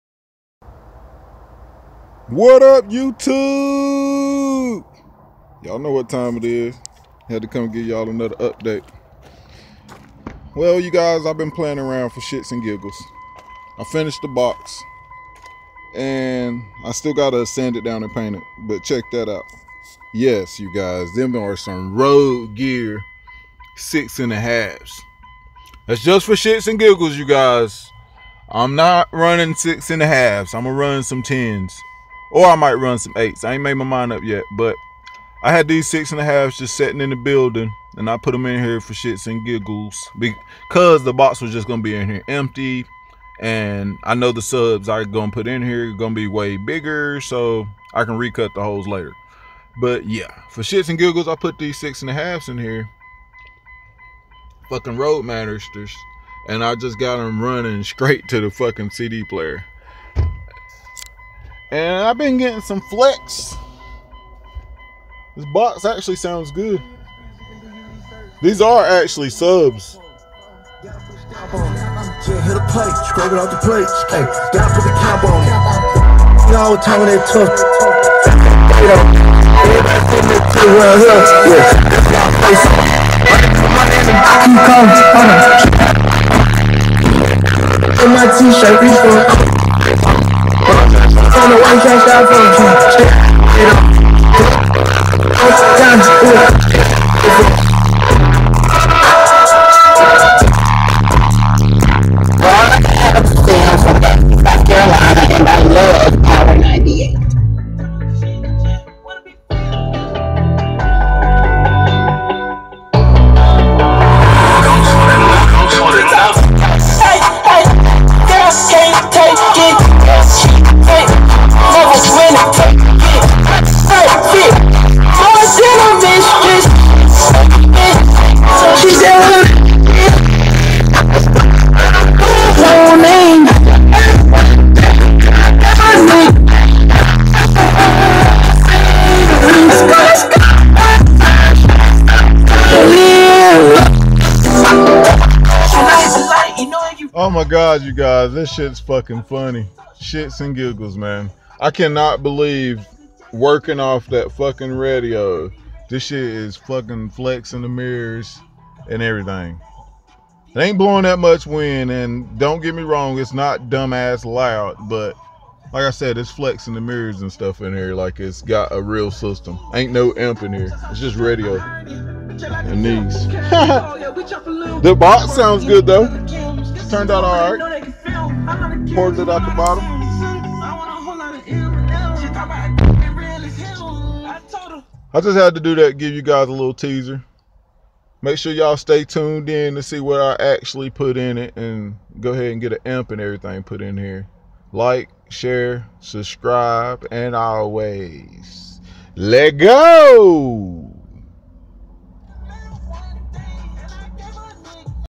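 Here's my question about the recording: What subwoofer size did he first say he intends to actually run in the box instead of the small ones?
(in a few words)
10s.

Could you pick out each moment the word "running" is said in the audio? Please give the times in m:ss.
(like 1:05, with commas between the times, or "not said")
0:29, 0:57.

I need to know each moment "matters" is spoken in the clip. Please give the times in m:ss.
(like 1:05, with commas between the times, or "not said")
0:55.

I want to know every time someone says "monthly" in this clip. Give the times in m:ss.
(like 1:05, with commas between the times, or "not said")
not said.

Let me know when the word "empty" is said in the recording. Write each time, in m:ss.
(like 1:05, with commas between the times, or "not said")
0:42.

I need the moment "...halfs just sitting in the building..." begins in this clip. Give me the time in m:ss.
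0:36.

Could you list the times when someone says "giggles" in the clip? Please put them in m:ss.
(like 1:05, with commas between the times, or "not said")
0:12, 0:26, 0:39, 0:50, 2:30.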